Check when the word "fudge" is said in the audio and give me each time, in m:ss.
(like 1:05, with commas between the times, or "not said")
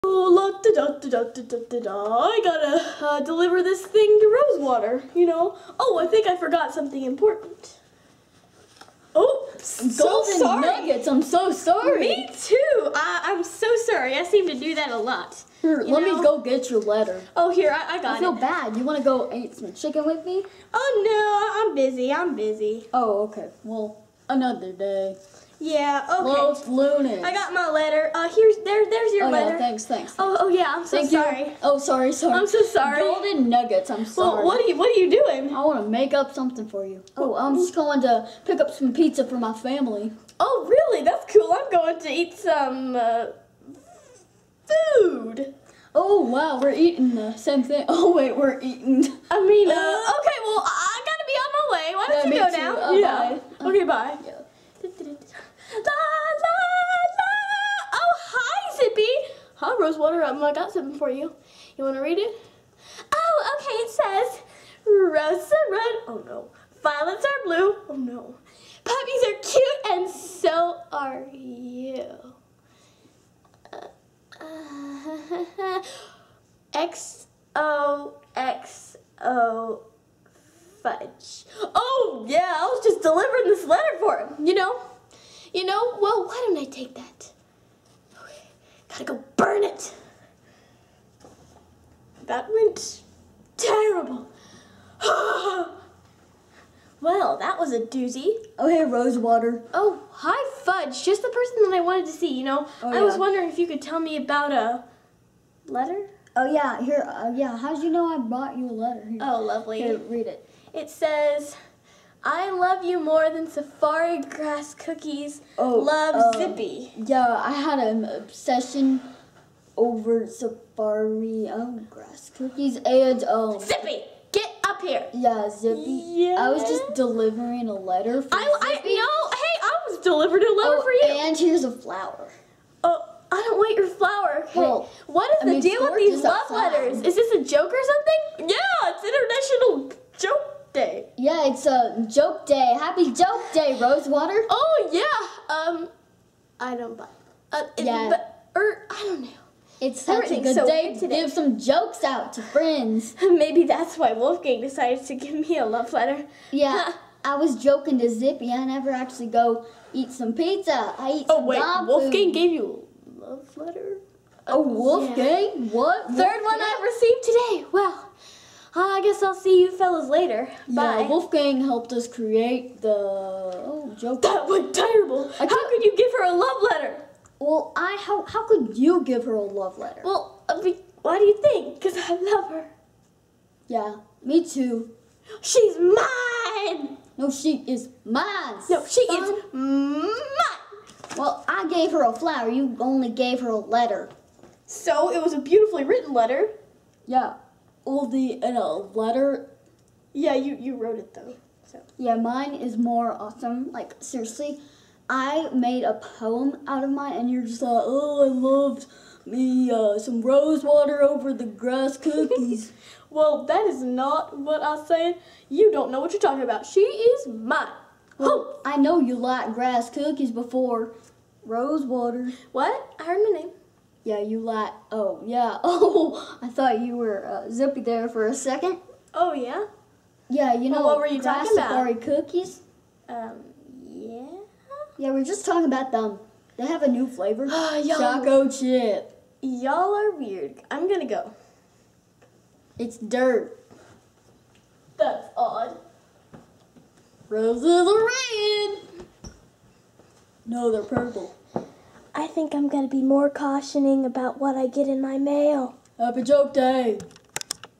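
1:20, 1:40.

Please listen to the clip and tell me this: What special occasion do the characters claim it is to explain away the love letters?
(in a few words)
International Joke Day.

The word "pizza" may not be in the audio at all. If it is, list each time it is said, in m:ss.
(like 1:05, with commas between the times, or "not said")
0:38, 2:40.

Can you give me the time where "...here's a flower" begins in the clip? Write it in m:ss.
2:11.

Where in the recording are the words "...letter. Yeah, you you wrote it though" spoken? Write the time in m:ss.
3:18.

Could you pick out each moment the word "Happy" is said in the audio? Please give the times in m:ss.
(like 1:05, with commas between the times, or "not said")
2:22, 4:15.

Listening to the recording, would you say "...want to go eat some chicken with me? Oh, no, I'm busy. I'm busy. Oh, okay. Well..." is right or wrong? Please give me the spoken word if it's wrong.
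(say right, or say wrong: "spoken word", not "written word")
right.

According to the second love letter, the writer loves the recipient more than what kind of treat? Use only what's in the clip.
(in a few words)
Safari grass cookies.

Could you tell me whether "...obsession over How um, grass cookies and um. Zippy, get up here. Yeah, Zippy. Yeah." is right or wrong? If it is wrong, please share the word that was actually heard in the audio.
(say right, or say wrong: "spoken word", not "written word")
wrong: "Safari", not "How".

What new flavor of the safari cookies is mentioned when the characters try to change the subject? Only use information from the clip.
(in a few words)
Choco chip.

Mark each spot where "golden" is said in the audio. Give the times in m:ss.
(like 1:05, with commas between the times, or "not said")
0:09, 0:32.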